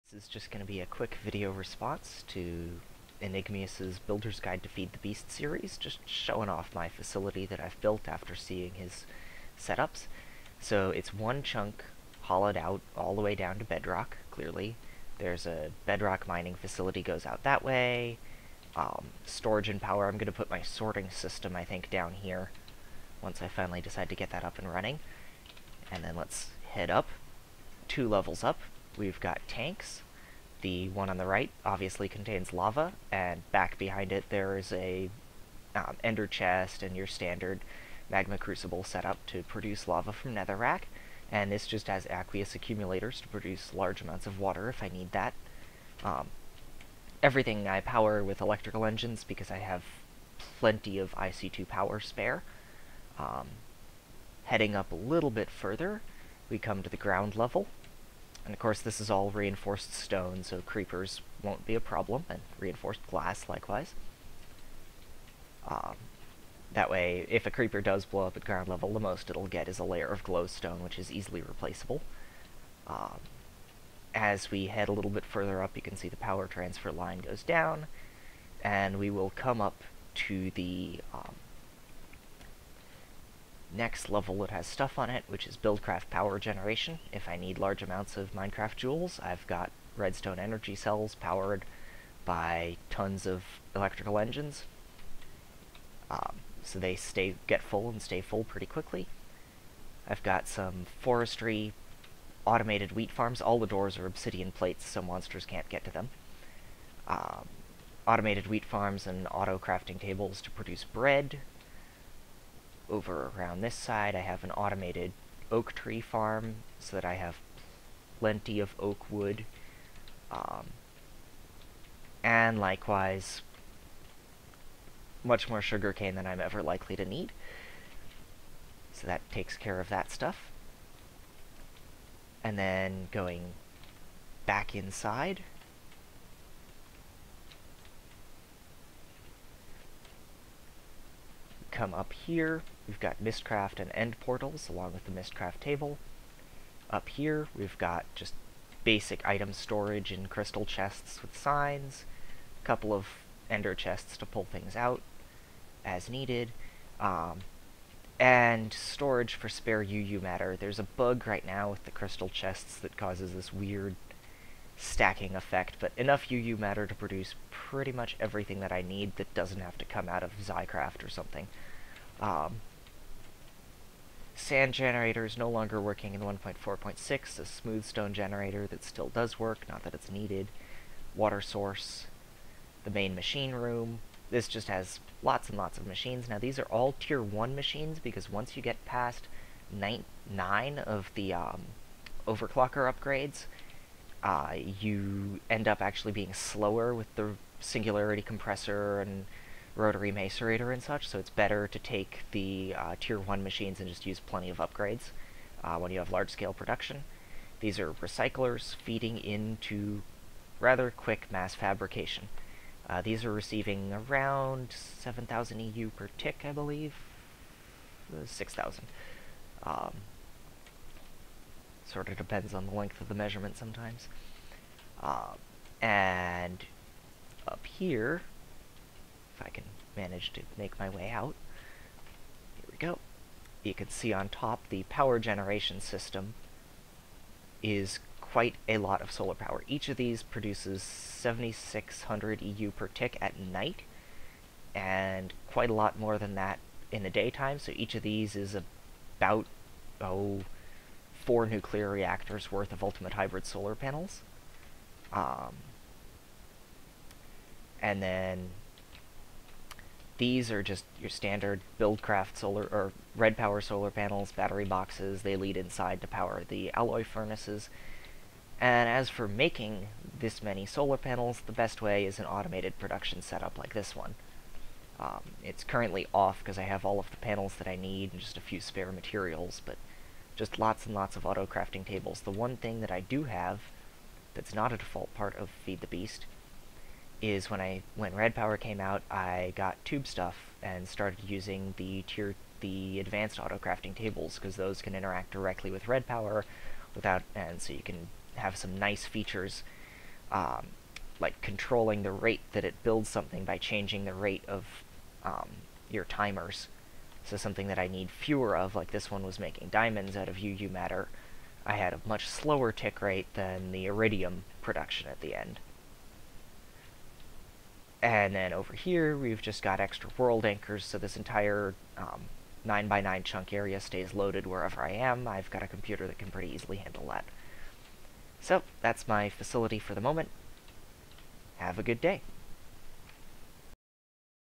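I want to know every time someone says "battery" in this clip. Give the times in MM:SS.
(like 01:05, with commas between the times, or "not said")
04:24.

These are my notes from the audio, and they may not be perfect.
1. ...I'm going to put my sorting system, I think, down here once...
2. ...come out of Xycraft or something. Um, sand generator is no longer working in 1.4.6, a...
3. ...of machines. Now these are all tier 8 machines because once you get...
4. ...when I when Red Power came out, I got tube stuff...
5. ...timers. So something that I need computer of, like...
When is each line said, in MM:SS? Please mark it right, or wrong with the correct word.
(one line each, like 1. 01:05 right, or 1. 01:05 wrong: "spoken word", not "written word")
1. 00:20 right
2. 02:49 right
3. 03:05 wrong: "1", not "8"
4. 04:47 right
5. 05:06 wrong: "fewer", not "computer".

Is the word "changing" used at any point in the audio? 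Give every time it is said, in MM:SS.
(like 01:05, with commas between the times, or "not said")
05:03.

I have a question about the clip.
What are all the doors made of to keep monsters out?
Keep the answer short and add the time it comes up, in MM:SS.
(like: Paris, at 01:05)
obsidian plates, at 01:44.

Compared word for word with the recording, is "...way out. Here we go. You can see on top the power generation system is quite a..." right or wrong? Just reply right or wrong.
right.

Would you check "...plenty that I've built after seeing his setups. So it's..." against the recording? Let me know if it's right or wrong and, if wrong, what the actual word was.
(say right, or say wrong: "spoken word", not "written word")
wrong: "facility", not "plenty".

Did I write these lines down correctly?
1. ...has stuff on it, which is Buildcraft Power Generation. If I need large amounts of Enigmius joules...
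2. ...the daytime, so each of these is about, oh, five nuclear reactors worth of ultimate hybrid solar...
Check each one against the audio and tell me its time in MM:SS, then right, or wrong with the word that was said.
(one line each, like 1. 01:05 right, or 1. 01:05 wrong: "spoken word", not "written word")
1. 01:24 wrong: "Minecraft", not "Enigmius"
2. 04:07 wrong: "four", not "five".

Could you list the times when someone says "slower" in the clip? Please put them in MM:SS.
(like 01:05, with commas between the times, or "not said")
03:16, 05:12.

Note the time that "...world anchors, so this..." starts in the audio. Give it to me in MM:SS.
05:20.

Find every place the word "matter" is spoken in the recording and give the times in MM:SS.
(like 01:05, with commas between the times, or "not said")
02:40, 02:46, 05:10.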